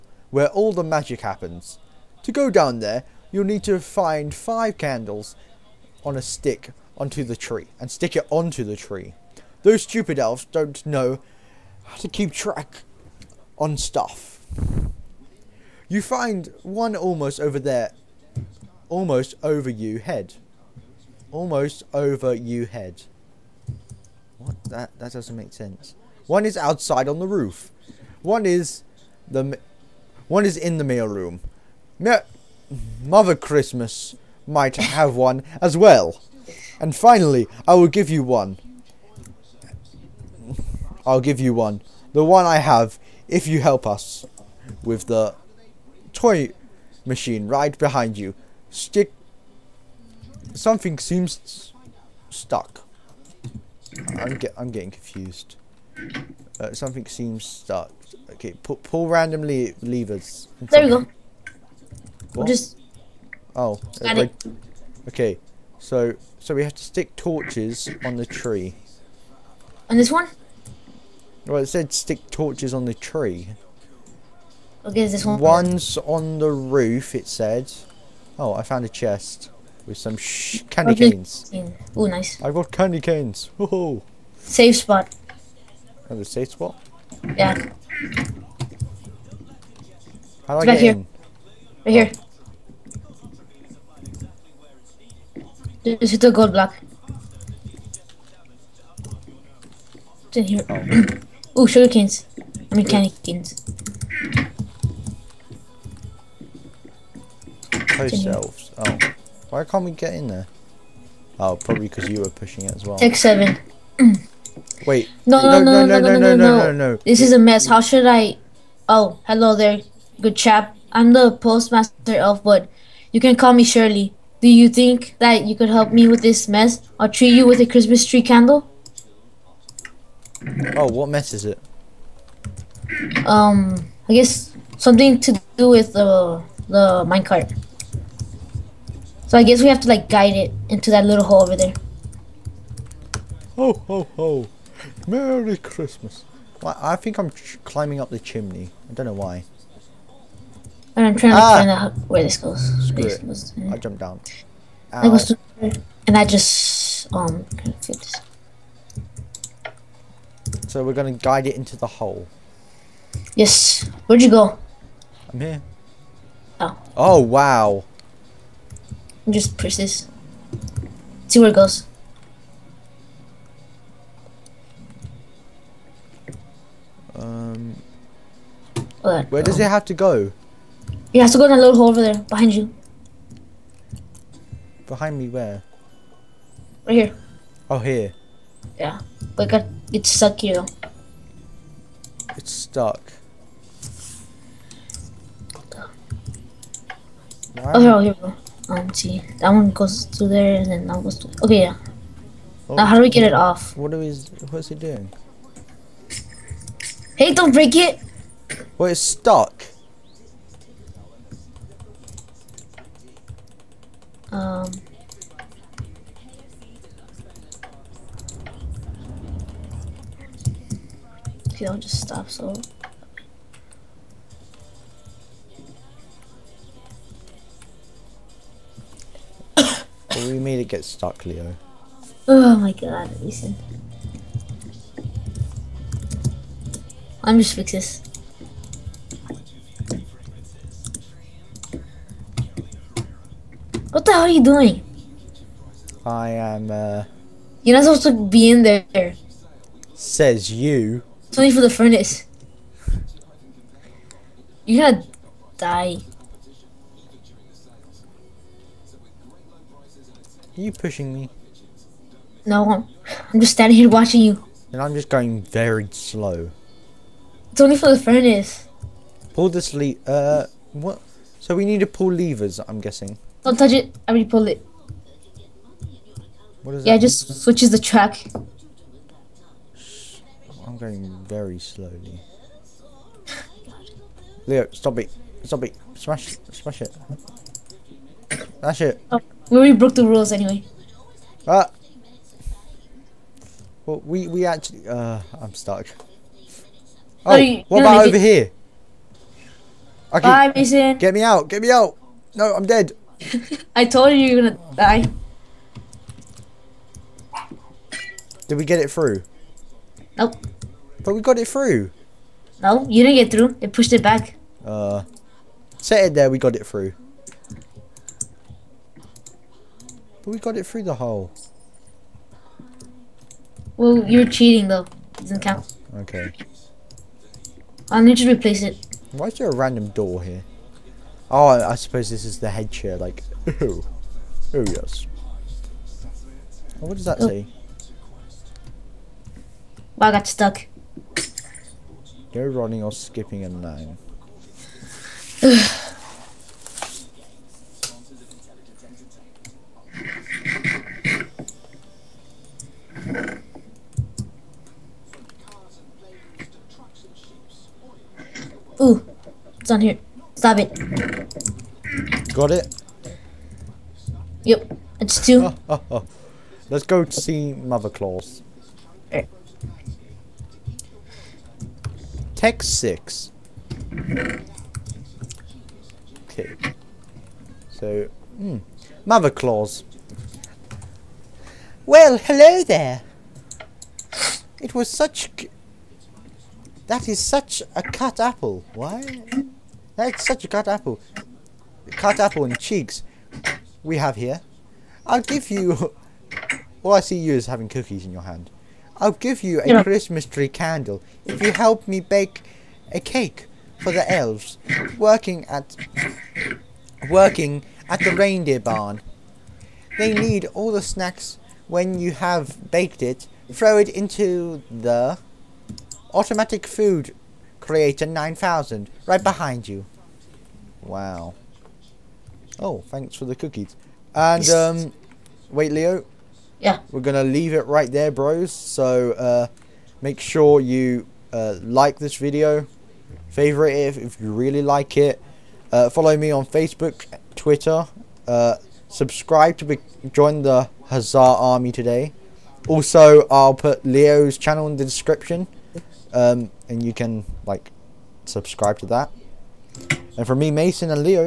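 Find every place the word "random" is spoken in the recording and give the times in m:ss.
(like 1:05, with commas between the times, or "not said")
5:29.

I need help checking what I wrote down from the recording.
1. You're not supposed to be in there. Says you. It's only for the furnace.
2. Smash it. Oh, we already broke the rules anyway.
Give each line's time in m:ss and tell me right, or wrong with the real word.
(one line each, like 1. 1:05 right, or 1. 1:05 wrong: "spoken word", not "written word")
1. 4:07 right
2. 4:48 right.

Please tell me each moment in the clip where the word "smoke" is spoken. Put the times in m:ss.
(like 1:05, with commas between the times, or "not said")
not said.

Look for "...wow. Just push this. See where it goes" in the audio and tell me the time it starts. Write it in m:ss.
2:47.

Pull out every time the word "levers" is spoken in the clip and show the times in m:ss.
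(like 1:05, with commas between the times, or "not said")
0:59, 4:32.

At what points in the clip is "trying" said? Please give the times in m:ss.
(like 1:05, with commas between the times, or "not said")
2:31.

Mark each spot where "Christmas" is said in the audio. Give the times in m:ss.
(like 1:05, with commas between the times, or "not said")
0:33, 2:07, 2:25, 6:39.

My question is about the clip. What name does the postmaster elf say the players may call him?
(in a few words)
Shirley.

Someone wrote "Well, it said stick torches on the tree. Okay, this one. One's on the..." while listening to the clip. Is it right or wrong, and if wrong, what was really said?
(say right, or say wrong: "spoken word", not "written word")
right.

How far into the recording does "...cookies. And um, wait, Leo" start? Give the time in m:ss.
7:03.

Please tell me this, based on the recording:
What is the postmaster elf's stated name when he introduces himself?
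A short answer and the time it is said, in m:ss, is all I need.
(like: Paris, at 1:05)
Elfwood, at 2:02.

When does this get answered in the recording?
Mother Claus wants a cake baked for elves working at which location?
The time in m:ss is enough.
6:48.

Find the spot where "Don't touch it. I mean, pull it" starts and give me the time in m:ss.
4:33.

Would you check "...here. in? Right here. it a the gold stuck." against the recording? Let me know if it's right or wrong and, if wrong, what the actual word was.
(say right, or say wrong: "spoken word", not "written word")
wrong: "block", not "stuck".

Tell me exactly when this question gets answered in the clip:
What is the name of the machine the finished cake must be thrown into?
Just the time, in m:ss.
6:56.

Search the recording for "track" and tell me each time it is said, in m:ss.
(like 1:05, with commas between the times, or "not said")
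0:12, 4:37.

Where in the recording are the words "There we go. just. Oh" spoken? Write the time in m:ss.
1:00.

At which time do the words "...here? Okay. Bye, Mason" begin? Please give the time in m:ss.
4:58.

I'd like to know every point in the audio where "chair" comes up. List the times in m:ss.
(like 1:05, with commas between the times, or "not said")
5:32.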